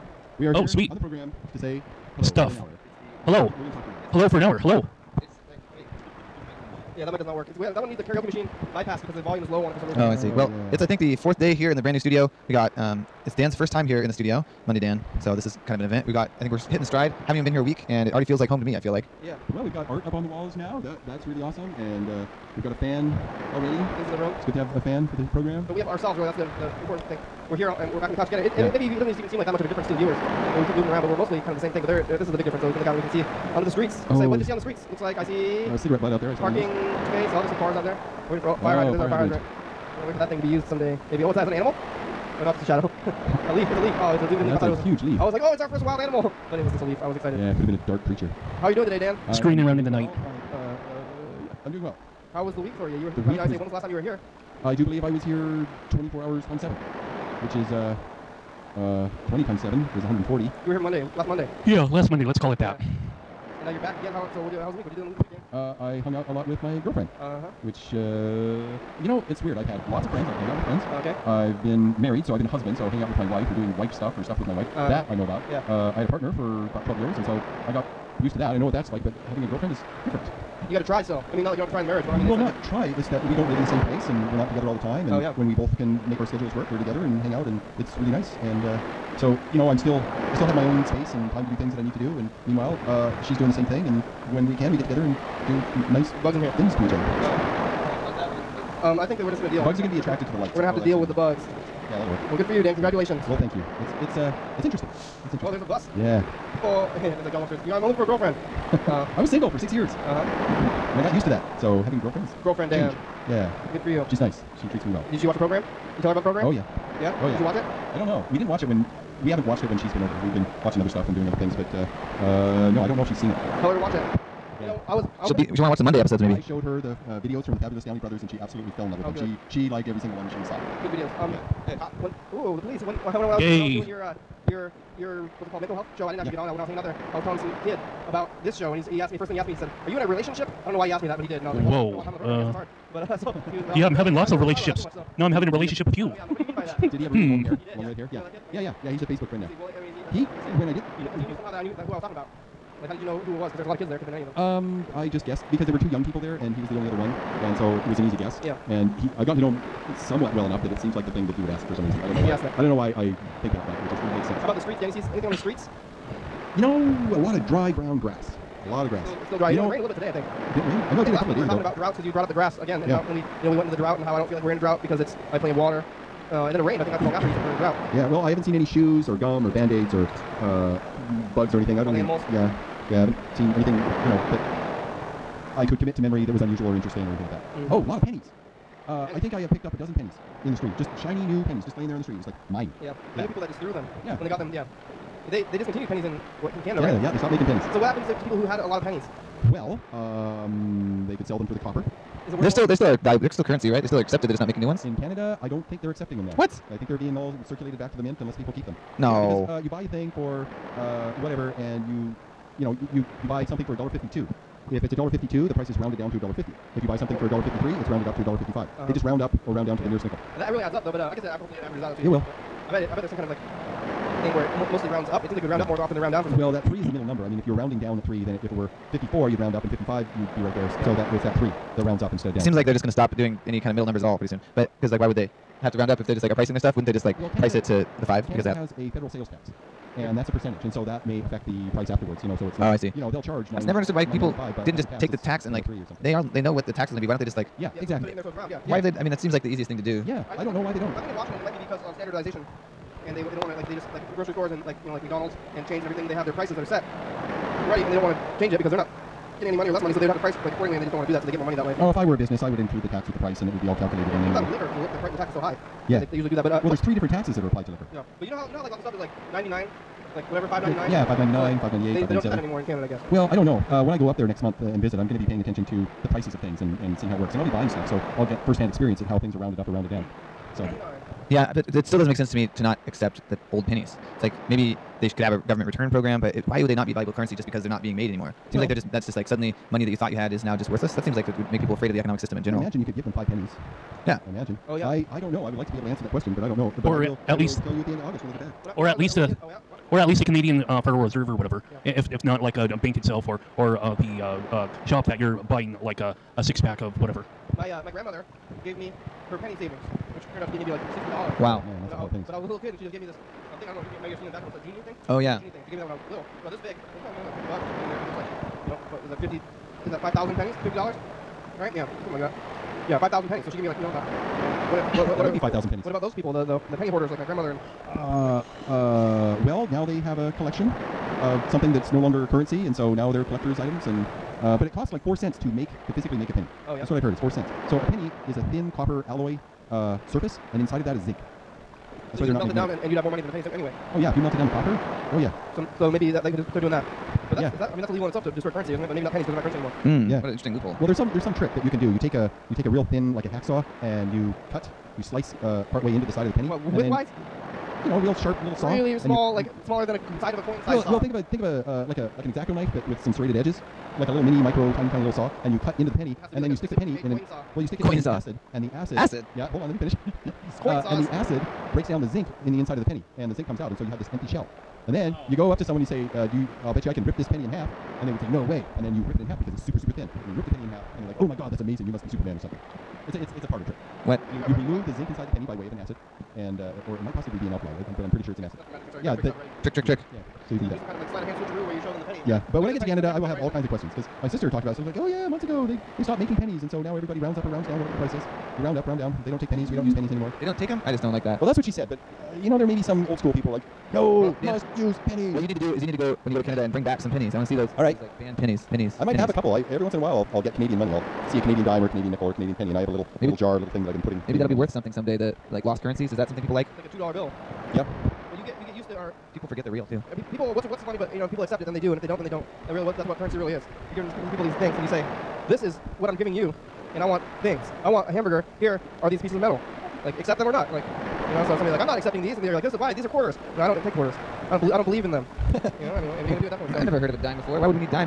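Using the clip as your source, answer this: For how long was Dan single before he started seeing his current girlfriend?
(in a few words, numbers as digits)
6 years.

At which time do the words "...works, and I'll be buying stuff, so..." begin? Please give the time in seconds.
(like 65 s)
277 s.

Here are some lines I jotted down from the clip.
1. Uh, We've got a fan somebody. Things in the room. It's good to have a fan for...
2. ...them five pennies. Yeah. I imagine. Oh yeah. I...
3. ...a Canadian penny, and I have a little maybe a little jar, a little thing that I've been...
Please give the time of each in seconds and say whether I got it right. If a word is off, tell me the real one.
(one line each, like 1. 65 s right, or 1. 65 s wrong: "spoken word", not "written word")
1. 22 s wrong: "already", not "somebody"
2. 293 s right
3. 412 s right.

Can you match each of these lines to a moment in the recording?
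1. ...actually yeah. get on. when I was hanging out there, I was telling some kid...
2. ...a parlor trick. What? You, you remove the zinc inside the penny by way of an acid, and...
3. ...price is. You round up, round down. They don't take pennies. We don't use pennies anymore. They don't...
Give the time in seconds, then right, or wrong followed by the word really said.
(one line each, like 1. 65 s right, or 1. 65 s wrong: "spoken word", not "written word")
1. 136 s right
2. 383 s right
3. 397 s right.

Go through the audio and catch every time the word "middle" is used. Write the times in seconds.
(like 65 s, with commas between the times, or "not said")
226 s, 233 s.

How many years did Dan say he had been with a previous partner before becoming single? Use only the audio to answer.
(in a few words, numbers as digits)
12 years.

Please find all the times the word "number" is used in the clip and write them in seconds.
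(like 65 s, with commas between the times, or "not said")
227 s, 233 s.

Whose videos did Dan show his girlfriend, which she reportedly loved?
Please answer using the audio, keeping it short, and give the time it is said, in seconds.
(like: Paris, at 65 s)
The Fabulous Downey Brothers, at 127 s.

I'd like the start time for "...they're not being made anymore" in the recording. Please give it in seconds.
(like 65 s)
287 s.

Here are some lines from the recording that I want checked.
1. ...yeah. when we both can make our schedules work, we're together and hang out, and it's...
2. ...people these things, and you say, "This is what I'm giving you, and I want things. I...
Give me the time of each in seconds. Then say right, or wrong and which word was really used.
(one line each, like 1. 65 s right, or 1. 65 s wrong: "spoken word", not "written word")
1. 85 s right
2. 424 s right.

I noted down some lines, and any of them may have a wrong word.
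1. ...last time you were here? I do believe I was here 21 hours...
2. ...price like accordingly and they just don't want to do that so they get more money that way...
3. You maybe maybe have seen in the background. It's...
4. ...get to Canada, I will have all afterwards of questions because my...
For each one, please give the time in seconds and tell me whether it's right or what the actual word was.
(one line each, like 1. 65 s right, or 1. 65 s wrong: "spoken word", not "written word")
1. 53 s wrong: "24", not "21"
2. 260 s right
3. 313 s right
4. 392 s wrong: "kinds", not "afterwards".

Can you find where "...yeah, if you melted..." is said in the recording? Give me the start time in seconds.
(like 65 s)
343 s.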